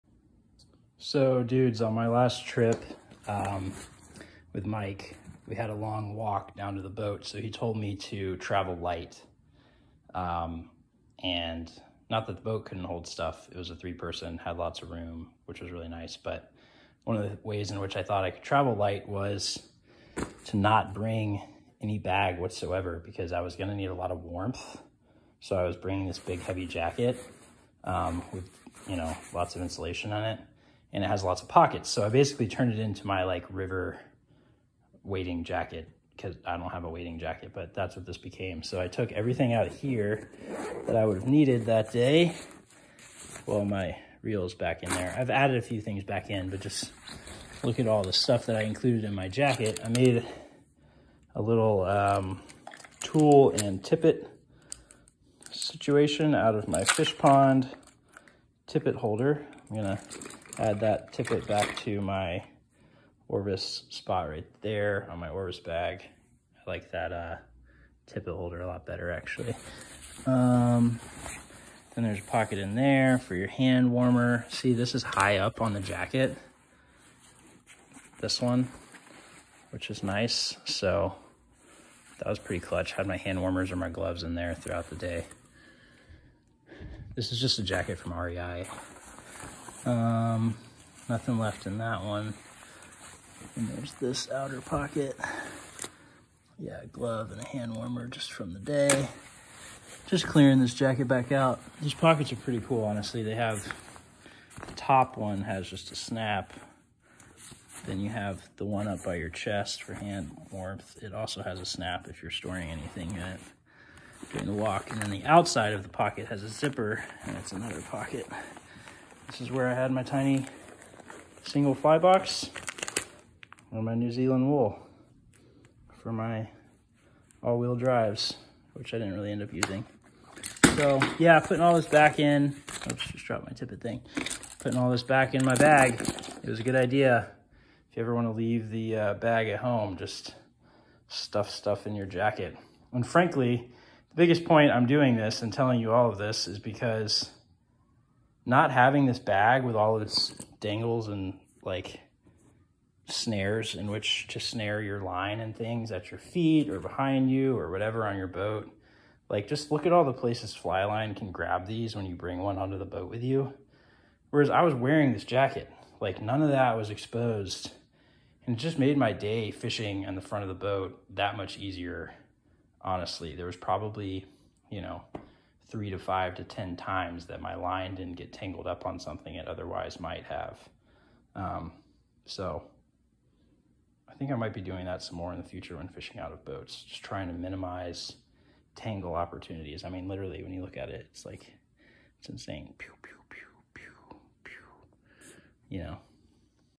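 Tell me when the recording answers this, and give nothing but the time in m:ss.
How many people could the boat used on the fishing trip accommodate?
0:13.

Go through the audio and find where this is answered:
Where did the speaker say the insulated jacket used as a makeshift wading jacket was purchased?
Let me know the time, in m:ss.
1:28.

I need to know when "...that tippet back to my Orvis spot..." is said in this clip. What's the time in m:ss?
1:00.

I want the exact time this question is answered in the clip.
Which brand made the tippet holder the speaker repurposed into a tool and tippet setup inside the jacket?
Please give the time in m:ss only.
0:56.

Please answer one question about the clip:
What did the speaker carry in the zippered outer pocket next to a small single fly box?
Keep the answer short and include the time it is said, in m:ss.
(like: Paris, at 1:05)
New Zealand wool, at 2:03.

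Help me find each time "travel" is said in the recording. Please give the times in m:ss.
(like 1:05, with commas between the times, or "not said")
0:08, 0:18.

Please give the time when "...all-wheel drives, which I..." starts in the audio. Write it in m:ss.
2:07.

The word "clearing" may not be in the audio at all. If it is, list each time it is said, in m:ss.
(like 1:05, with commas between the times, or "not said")
1:40.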